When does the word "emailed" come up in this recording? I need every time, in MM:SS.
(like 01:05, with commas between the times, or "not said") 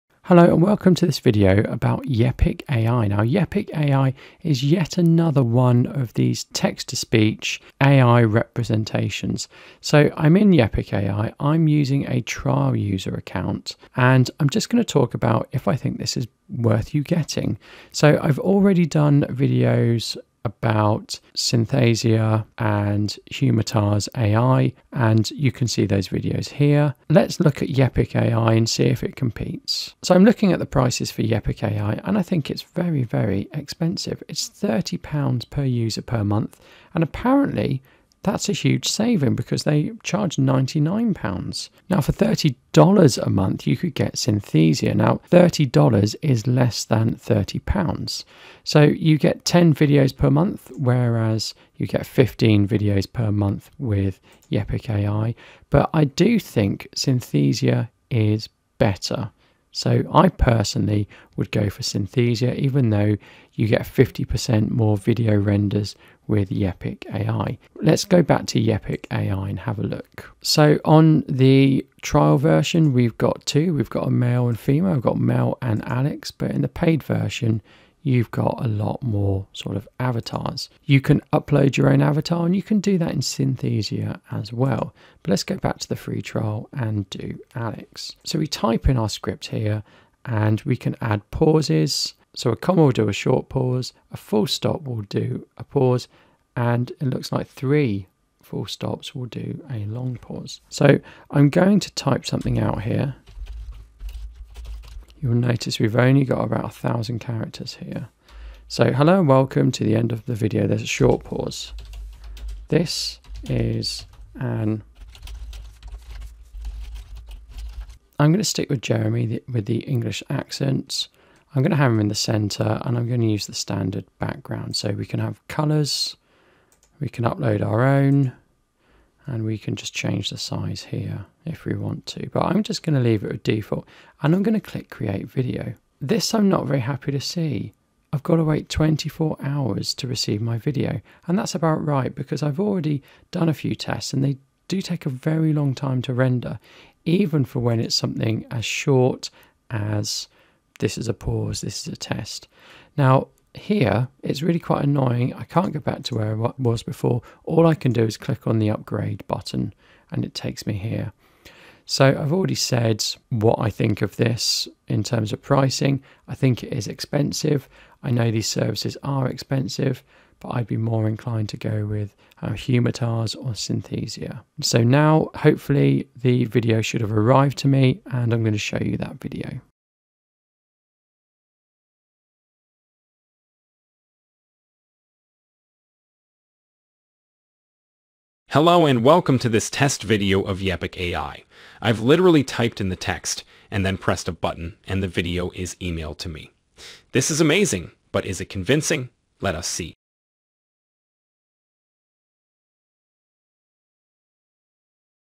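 03:15.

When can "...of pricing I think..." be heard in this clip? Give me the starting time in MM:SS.
02:45.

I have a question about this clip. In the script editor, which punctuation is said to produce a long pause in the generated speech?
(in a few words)
three full stops.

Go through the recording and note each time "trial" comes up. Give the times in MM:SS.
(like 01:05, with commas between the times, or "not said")
00:12, 01:12, 01:26.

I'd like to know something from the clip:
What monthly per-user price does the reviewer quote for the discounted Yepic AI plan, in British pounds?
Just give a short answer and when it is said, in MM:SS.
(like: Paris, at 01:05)
£30, at 00:34.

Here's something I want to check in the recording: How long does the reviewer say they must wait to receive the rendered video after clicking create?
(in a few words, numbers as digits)
24 hours.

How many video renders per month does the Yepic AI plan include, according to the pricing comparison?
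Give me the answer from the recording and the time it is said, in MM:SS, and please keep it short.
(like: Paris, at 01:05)
15, at 00:52.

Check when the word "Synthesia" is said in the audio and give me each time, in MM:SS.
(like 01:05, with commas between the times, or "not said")
00:21, 00:44, 00:56, 01:01, 01:23, 02:53.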